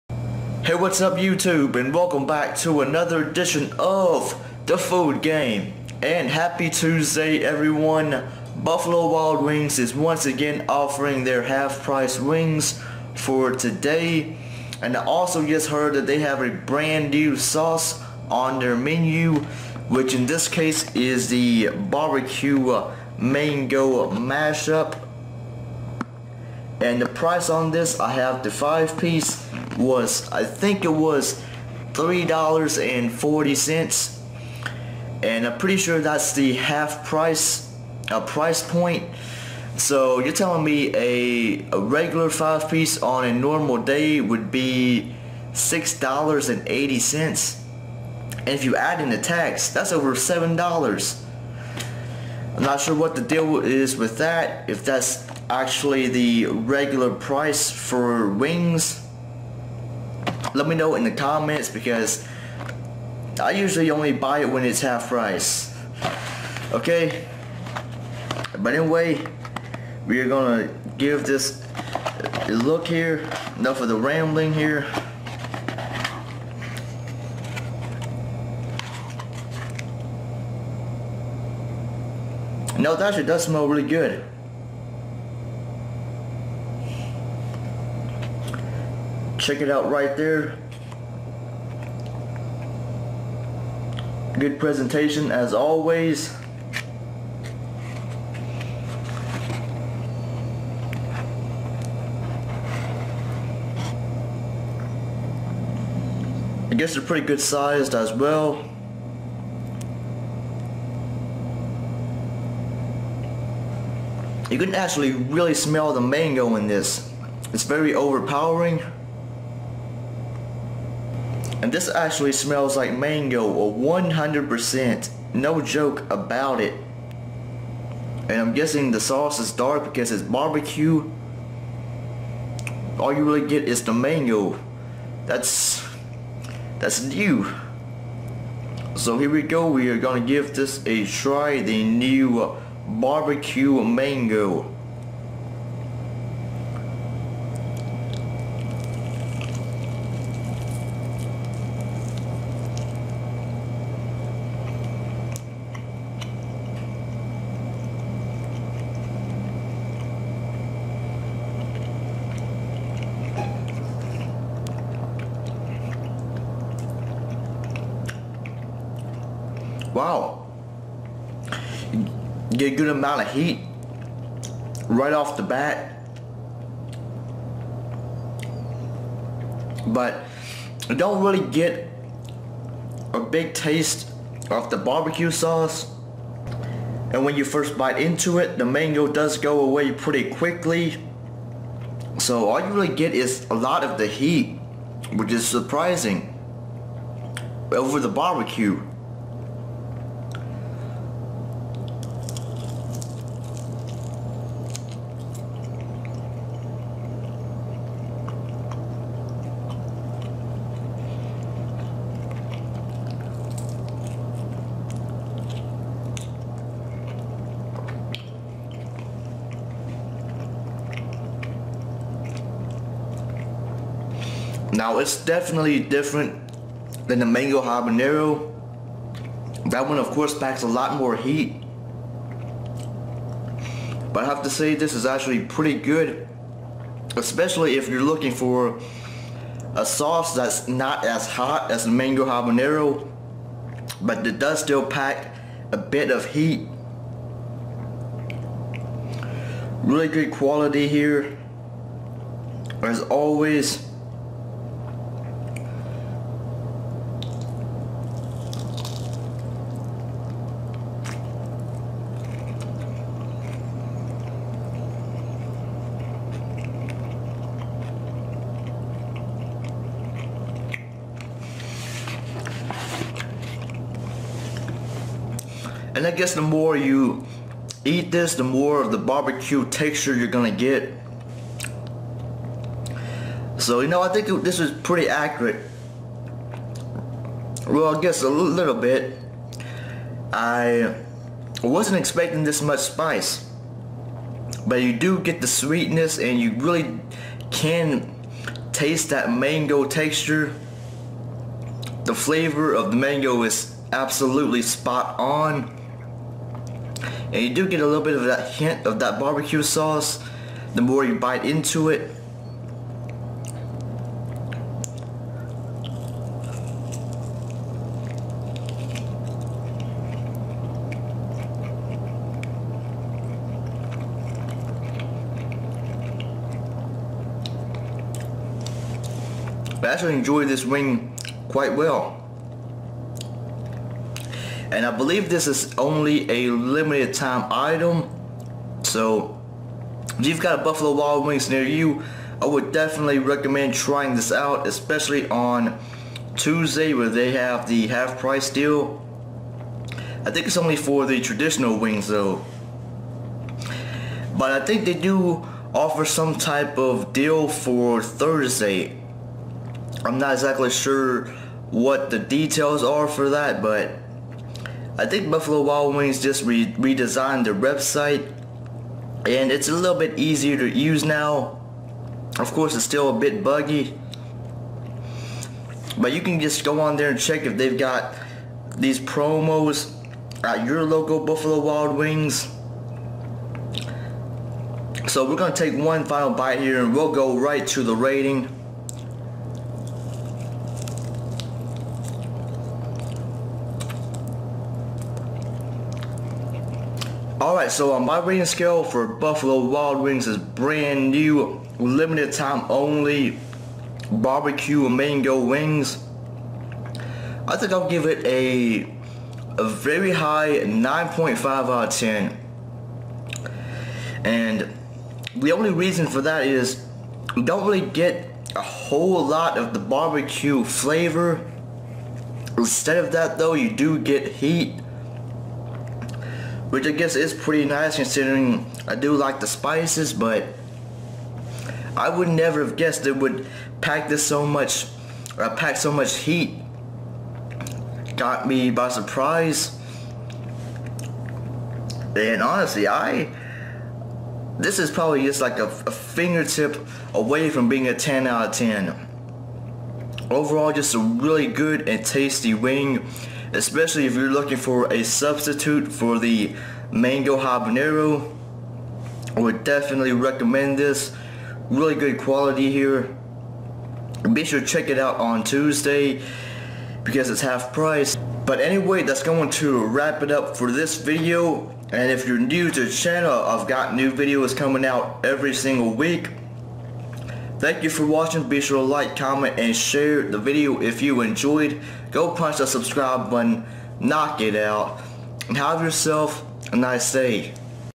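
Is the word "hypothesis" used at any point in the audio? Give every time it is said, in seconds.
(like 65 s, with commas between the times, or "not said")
not said.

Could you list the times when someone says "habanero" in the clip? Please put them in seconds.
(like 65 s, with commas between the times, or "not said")
227 s, 242 s, 457 s.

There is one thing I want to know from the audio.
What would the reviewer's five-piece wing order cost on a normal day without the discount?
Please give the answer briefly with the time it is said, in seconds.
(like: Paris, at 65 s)
$6.80, at 45 s.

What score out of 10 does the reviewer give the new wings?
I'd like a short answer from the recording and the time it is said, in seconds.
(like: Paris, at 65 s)
9.5, at 410 s.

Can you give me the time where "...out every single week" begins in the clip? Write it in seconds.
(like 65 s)
474 s.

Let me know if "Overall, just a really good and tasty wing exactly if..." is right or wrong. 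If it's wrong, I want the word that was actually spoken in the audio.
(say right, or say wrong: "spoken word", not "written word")
wrong: "especially", not "exactly".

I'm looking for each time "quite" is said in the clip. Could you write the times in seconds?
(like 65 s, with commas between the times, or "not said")
331 s.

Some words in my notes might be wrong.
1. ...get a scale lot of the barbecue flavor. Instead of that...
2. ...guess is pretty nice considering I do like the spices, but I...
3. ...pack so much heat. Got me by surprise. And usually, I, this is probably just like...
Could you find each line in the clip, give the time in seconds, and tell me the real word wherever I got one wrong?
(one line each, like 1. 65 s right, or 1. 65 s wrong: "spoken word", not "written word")
1. 417 s wrong: "whole", not "scale"
2. 426 s right
3. 435 s wrong: "honestly", not "usually".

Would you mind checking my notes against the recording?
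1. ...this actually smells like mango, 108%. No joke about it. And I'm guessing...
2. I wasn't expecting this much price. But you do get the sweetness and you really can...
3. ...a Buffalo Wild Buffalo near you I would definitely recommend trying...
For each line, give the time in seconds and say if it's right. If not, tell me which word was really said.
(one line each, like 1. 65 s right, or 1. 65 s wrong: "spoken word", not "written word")
1. 121 s wrong: "100", not "108"
2. 290 s wrong: "spice", not "price"
3. 340 s wrong: "Wings", not "Buffalo".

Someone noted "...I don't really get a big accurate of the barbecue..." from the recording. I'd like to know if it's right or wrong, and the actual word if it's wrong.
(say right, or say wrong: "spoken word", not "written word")
wrong: "taste", not "accurate".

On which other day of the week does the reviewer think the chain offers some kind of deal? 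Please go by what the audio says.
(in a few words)
Thursday.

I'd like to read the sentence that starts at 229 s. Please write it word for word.
That one of course packs a lot more heat.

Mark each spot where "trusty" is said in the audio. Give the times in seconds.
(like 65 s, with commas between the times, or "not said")
not said.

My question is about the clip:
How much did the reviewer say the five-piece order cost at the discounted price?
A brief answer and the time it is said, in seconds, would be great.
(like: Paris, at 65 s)
$3.40, at 31 s.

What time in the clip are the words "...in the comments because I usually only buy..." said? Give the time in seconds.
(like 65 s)
60 s.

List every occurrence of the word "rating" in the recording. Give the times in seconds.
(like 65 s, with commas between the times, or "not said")
387 s, 398 s.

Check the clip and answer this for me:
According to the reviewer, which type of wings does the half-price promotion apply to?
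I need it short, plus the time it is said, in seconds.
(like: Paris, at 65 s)
traditional wings, at 351 s.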